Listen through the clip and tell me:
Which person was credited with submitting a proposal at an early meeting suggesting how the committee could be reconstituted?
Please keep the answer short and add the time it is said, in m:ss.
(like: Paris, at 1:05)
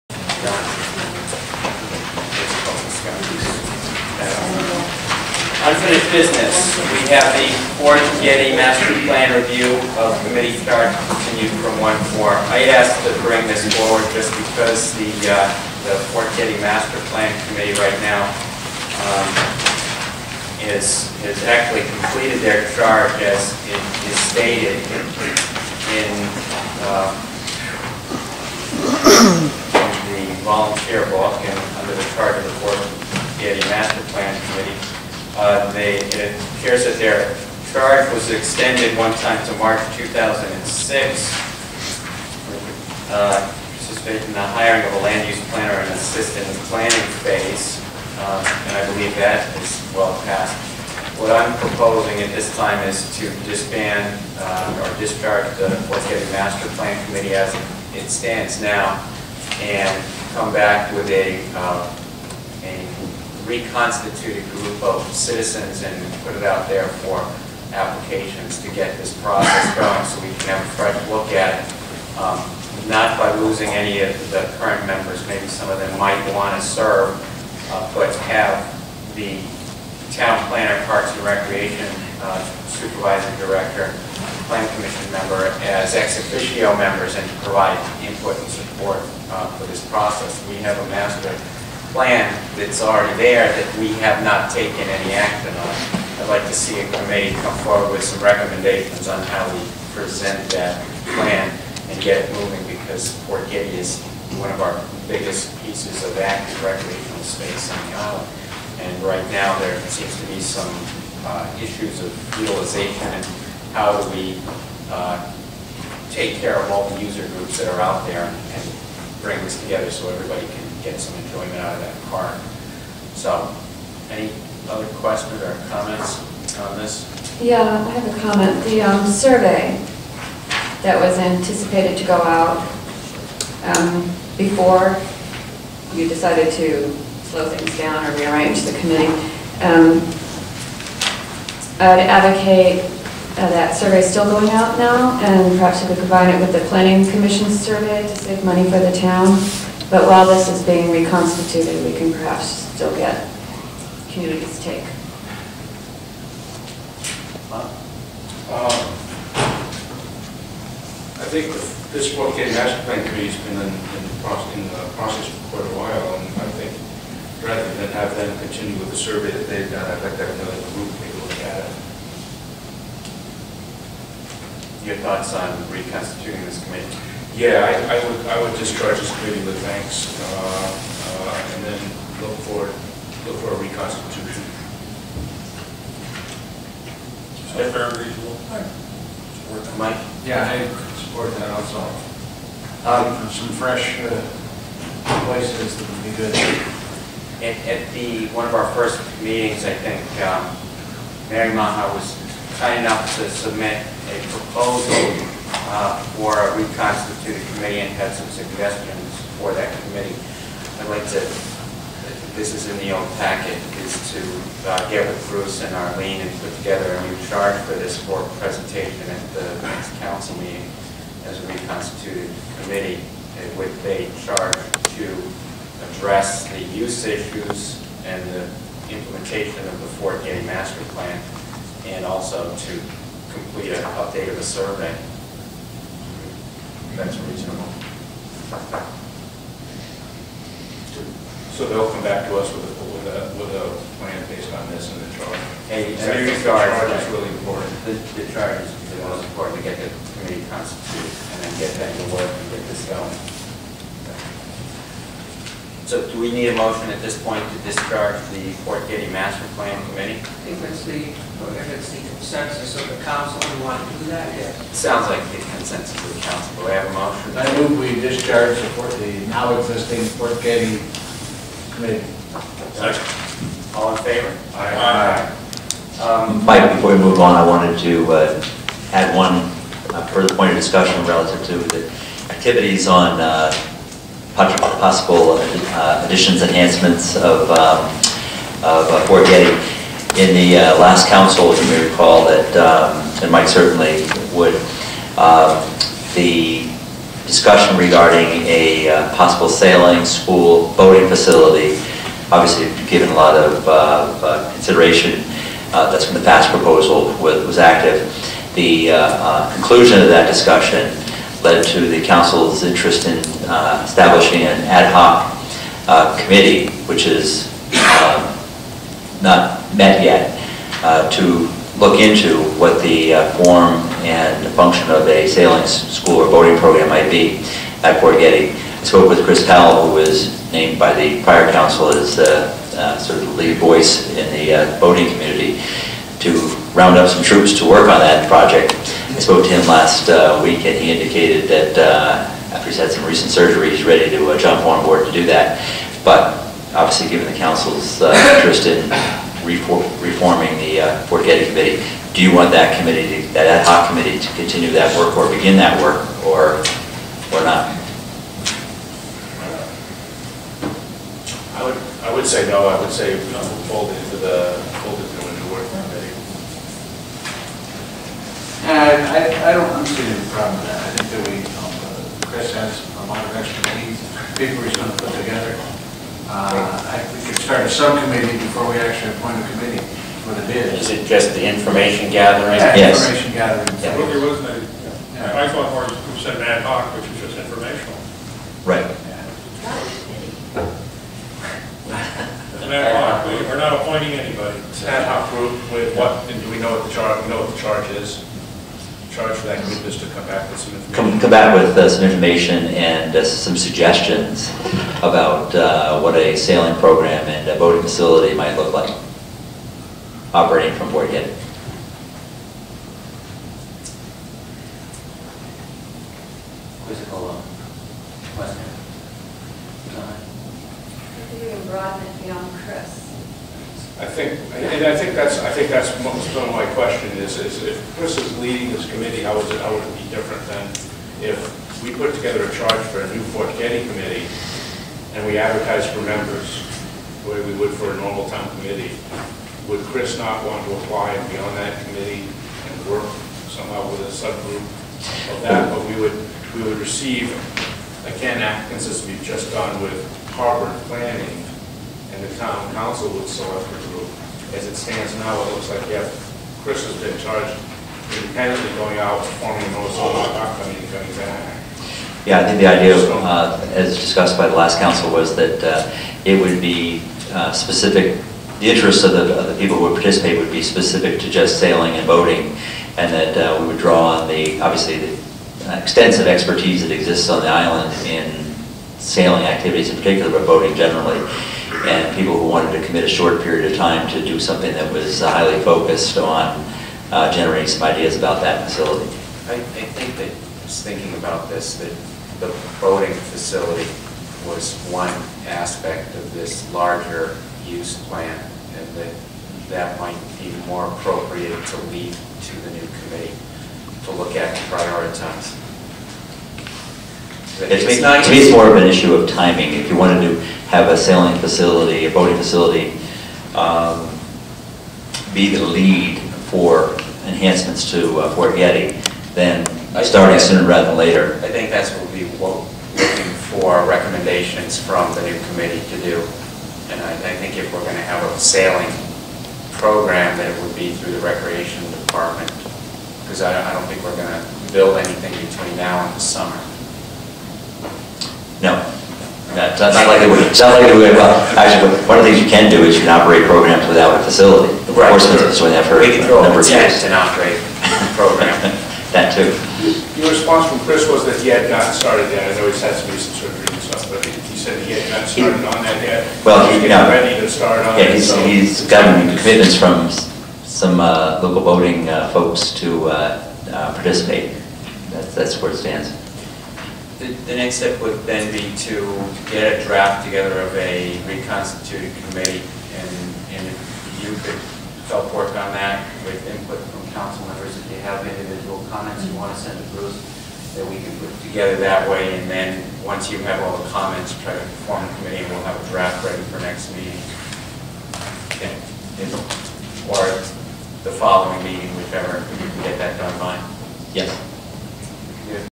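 Mary Maha, at 3:21.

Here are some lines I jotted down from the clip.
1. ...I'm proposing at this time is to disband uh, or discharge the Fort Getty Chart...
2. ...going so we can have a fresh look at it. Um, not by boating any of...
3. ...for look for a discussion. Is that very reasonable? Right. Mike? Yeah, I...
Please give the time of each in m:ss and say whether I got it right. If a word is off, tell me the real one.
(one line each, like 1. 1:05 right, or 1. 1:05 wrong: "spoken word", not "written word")
1. 0:51 wrong: "Master", not "Chart"
2. 1:09 wrong: "losing", not "boating"
3. 3:02 wrong: "reconstitution", not "discussion".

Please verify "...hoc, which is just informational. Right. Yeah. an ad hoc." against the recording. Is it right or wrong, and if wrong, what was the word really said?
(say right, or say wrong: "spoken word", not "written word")
right.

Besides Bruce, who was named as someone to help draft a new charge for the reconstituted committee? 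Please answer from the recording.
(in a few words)
Arlene.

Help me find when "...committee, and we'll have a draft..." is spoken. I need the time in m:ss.
9:45.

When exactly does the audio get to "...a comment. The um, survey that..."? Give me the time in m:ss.
2:08.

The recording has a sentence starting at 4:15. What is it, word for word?
So do we need a motion at this point to discharge the Fort Getty Master Plan Committee?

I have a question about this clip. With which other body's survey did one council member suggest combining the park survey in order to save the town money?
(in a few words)
Planning Commission.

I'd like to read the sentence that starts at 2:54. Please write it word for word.
Your thoughts on reconstituting this committee?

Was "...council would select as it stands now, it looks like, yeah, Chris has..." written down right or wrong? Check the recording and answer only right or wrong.
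right.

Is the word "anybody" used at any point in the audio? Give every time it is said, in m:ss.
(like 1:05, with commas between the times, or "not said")
6:34.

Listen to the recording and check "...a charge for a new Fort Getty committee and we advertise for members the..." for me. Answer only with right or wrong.
right.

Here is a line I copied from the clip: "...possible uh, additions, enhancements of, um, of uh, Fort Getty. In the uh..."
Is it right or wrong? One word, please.
right.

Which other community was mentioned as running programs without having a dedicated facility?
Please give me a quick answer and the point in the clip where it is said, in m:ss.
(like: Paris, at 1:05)
Portsmouth, at 9:05.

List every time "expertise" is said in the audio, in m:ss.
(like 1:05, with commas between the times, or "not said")
6:13, 7:56.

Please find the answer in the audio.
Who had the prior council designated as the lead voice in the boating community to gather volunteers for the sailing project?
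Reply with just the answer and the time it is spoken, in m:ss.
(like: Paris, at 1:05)
Chris Powell, at 5:29.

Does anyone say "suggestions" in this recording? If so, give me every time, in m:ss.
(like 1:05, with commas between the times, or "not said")
3:28, 6:43.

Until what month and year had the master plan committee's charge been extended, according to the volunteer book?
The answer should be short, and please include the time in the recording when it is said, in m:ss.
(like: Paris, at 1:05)
March 2006, at 0:39.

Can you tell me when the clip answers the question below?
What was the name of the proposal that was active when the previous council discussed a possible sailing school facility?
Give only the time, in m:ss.
5:06.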